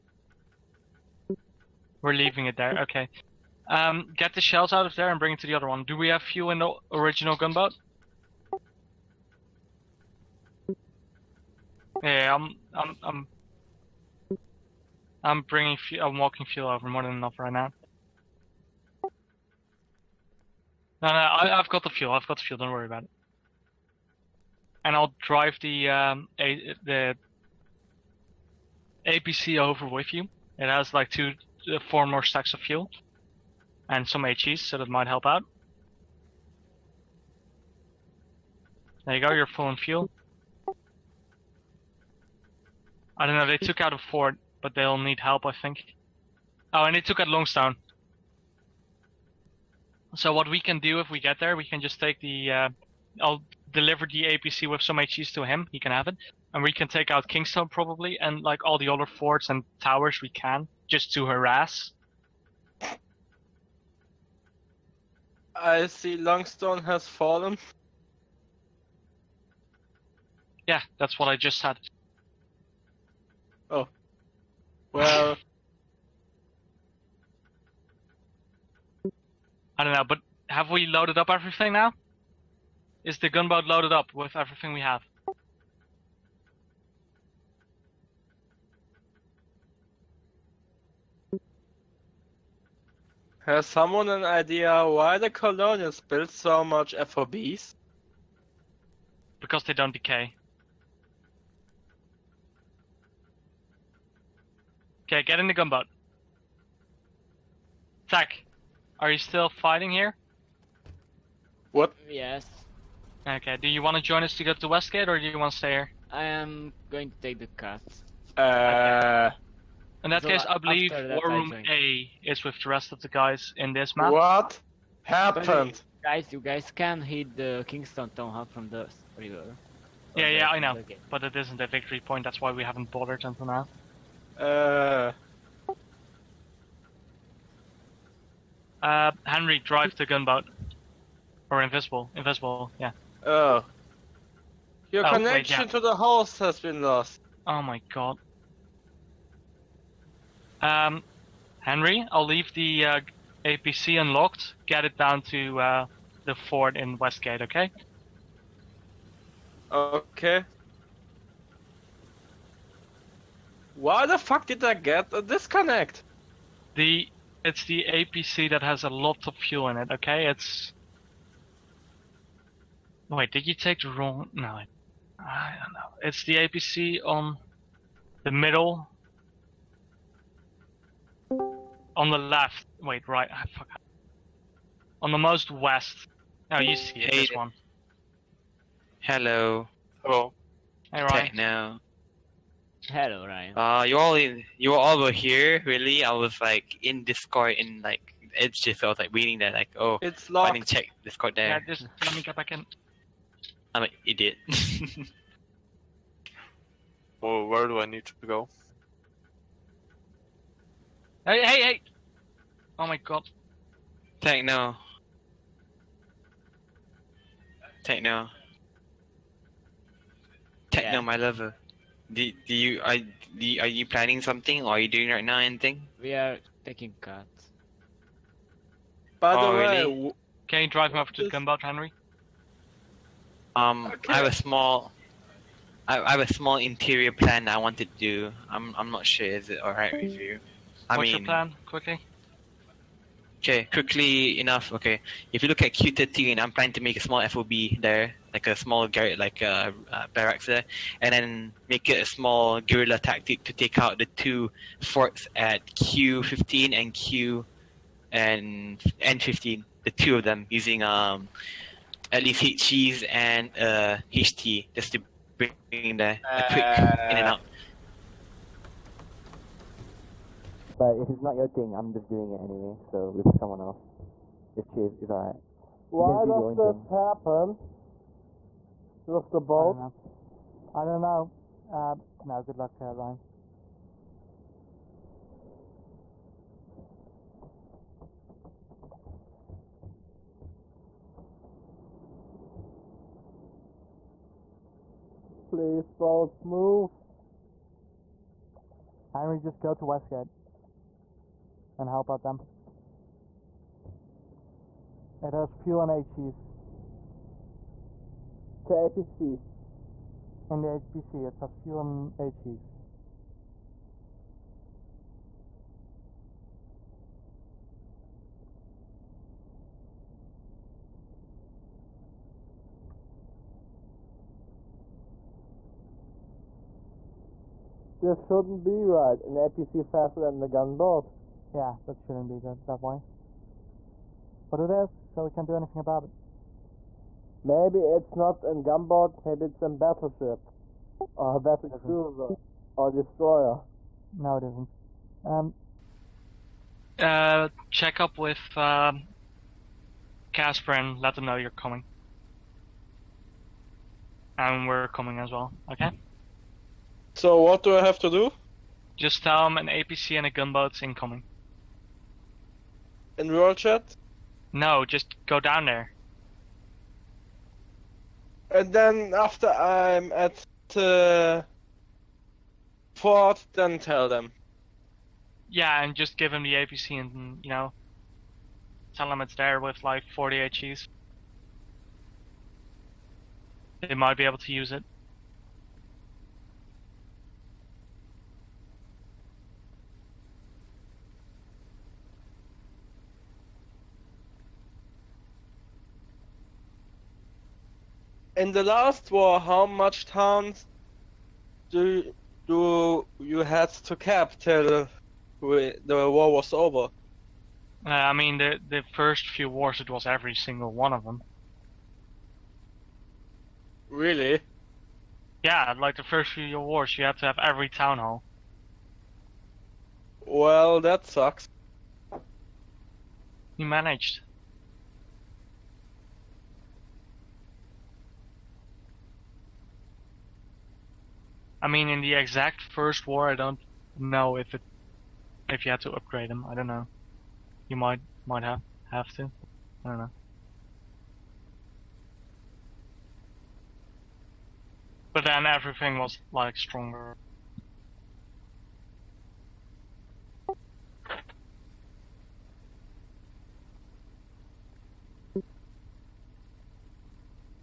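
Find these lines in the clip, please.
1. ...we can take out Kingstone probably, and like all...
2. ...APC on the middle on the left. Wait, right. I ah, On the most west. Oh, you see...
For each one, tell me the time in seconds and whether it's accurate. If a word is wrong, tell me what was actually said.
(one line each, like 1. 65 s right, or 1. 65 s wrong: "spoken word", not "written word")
1. 56 s right
2. 176 s right.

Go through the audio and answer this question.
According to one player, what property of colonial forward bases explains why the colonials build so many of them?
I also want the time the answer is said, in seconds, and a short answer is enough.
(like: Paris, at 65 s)
They don't decay, at 99 s.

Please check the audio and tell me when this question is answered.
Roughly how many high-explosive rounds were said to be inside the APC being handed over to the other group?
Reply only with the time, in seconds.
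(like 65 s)
380 s.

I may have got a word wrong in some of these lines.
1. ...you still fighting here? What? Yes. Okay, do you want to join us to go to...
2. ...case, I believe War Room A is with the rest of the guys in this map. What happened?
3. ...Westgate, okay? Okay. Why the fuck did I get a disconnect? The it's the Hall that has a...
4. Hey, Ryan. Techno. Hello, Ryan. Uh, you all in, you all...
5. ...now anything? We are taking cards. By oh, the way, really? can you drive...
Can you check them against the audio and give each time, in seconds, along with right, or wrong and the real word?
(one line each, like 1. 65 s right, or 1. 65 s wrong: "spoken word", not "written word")
1. 109 s right
2. 120 s right
3. 156 s wrong: "APC", not "Hall"
4. 190 s right
5. 225 s right.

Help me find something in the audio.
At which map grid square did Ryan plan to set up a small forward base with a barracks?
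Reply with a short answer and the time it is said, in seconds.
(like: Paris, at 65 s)
Q13, at 245 s.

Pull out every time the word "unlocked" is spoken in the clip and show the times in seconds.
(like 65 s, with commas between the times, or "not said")
153 s.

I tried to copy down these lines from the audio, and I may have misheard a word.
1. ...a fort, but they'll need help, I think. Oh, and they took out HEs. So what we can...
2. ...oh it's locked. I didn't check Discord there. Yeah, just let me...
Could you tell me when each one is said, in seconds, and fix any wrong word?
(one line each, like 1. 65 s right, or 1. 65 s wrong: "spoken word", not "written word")
1. 43 s wrong: "Longstone", not "HEs"
2. 199 s right.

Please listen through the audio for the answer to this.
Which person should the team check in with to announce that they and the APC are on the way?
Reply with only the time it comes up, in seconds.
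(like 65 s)
350 s.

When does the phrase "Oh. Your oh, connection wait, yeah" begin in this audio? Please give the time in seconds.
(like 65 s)
143 s.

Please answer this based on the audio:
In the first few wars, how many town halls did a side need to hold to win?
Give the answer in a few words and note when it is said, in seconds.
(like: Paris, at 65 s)
Every single one, at 410 s.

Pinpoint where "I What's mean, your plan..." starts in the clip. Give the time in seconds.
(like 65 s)
240 s.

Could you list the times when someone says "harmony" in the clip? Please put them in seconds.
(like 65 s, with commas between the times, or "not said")
not said.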